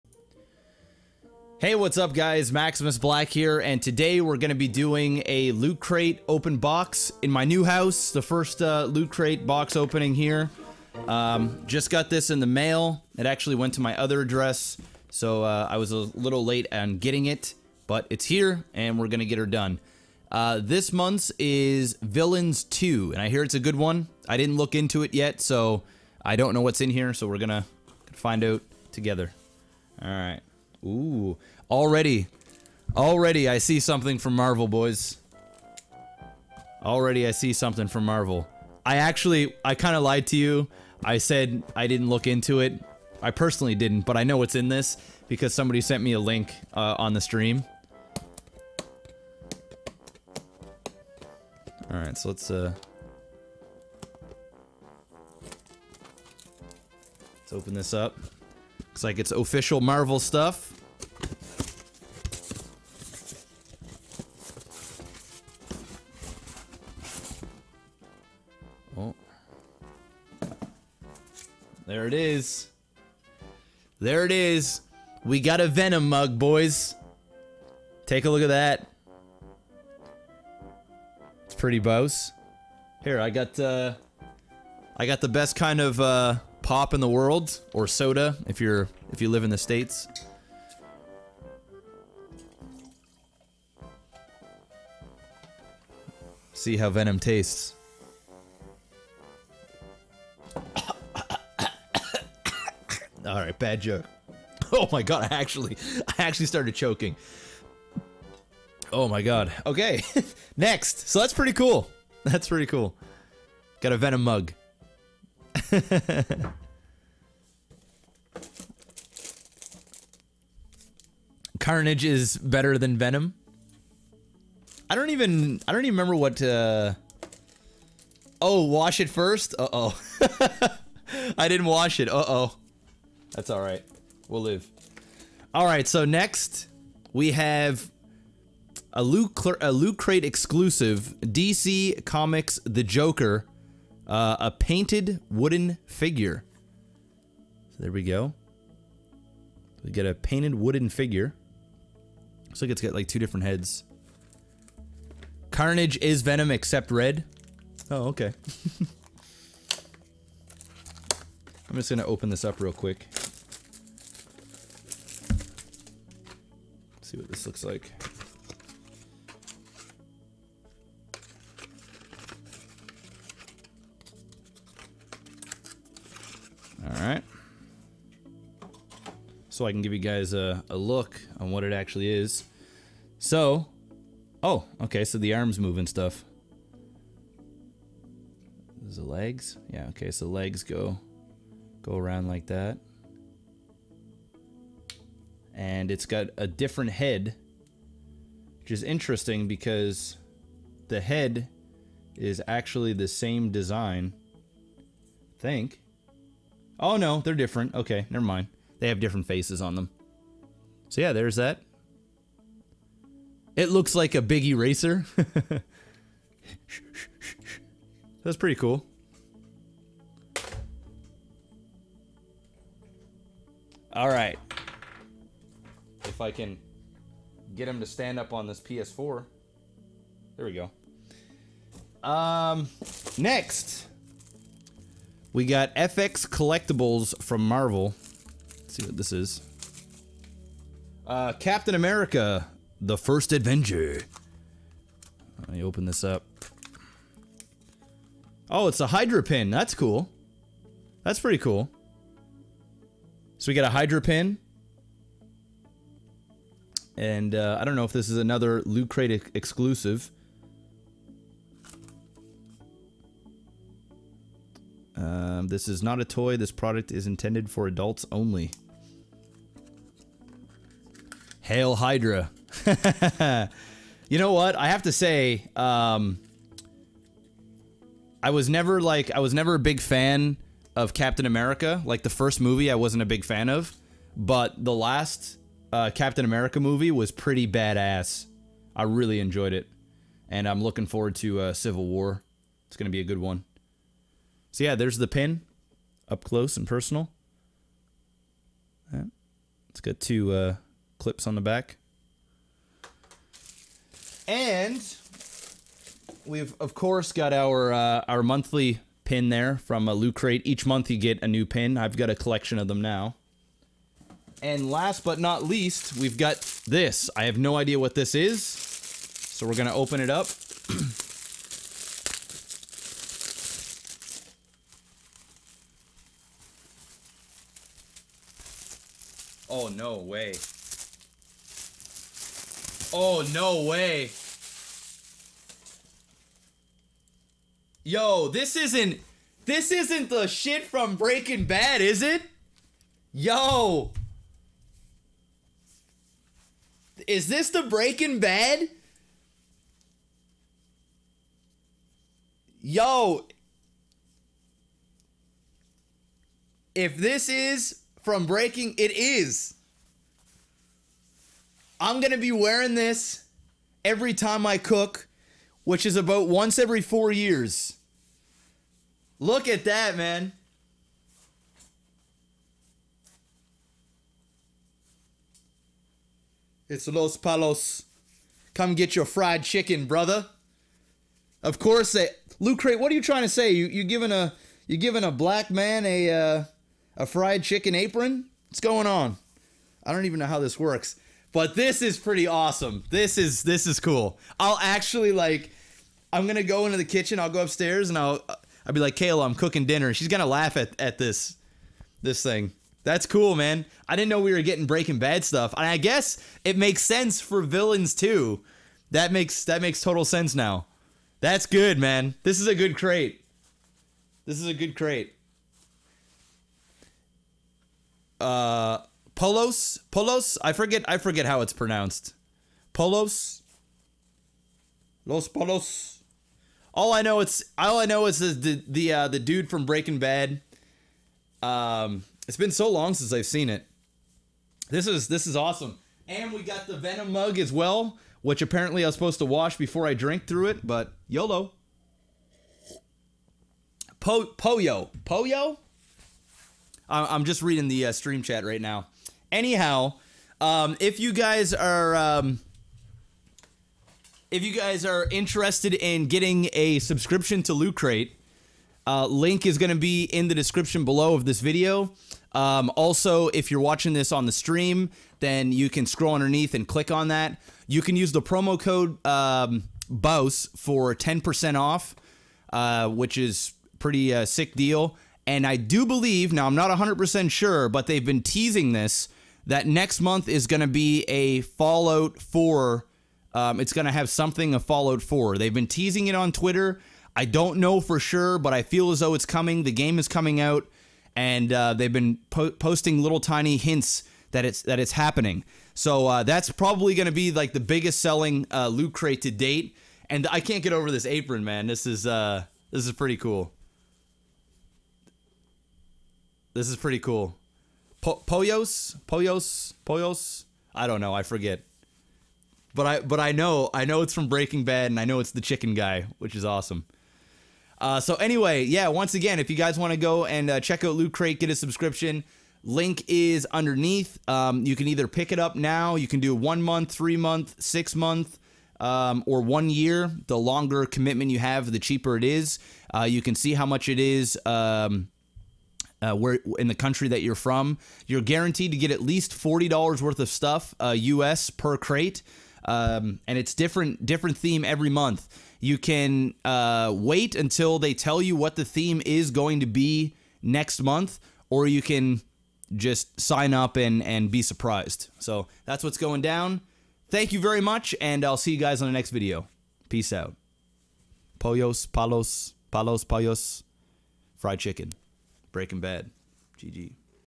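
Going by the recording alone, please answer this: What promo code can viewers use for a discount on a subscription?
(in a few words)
BOUSE.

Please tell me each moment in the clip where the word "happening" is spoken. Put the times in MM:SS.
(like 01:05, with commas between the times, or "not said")
08:14.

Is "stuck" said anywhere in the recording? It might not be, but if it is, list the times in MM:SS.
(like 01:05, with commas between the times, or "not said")
not said.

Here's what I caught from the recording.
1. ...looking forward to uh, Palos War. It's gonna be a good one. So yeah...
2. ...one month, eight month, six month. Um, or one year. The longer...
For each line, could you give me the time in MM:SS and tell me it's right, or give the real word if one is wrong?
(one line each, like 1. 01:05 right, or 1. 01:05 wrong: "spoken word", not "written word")
1. 04:50 wrong: "Civil", not "Palos"
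2. 08:46 wrong: "three", not "eight".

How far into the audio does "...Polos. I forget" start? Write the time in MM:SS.
06:59.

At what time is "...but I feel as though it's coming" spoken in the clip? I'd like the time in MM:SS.
08:08.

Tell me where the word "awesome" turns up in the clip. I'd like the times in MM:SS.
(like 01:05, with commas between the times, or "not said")
06:32, 07:15, 08:36.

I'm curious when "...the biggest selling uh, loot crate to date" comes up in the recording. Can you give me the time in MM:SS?
08:17.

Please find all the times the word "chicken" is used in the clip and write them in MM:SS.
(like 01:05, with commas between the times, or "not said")
06:19, 06:27, 08:35, 09:24.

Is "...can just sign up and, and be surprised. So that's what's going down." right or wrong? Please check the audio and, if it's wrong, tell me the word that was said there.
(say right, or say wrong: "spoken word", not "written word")
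right.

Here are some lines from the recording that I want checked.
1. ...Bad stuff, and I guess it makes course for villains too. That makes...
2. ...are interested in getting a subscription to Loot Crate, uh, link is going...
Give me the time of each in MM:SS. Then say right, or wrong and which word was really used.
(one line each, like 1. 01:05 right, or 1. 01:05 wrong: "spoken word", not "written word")
1. 06:44 wrong: "sense", not "course"
2. 07:34 right.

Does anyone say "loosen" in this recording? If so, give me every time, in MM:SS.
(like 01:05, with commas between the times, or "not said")
not said.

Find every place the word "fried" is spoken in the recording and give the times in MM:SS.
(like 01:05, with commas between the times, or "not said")
06:19, 06:27, 09:24.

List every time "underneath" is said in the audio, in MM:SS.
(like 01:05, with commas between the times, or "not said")
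07:46, 08:43.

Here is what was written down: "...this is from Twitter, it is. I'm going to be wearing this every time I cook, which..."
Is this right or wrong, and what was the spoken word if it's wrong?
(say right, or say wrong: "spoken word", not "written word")
wrong: "Breaking", not "Twitter".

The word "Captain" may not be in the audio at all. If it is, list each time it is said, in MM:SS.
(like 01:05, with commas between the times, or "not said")
04:01, 04:40, 04:45.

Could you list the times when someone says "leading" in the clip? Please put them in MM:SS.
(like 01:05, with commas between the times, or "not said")
not said.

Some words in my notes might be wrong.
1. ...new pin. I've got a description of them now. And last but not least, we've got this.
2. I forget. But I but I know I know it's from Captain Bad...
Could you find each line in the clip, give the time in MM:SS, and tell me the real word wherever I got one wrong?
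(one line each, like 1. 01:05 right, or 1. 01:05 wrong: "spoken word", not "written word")
1. 05:11 wrong: "collection", not "description"
2. 08:31 wrong: "Breaking", not "Captain".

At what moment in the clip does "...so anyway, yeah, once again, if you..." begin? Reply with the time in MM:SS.
08:37.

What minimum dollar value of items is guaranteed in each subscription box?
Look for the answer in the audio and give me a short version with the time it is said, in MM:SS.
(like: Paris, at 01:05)
$40, at 08:59.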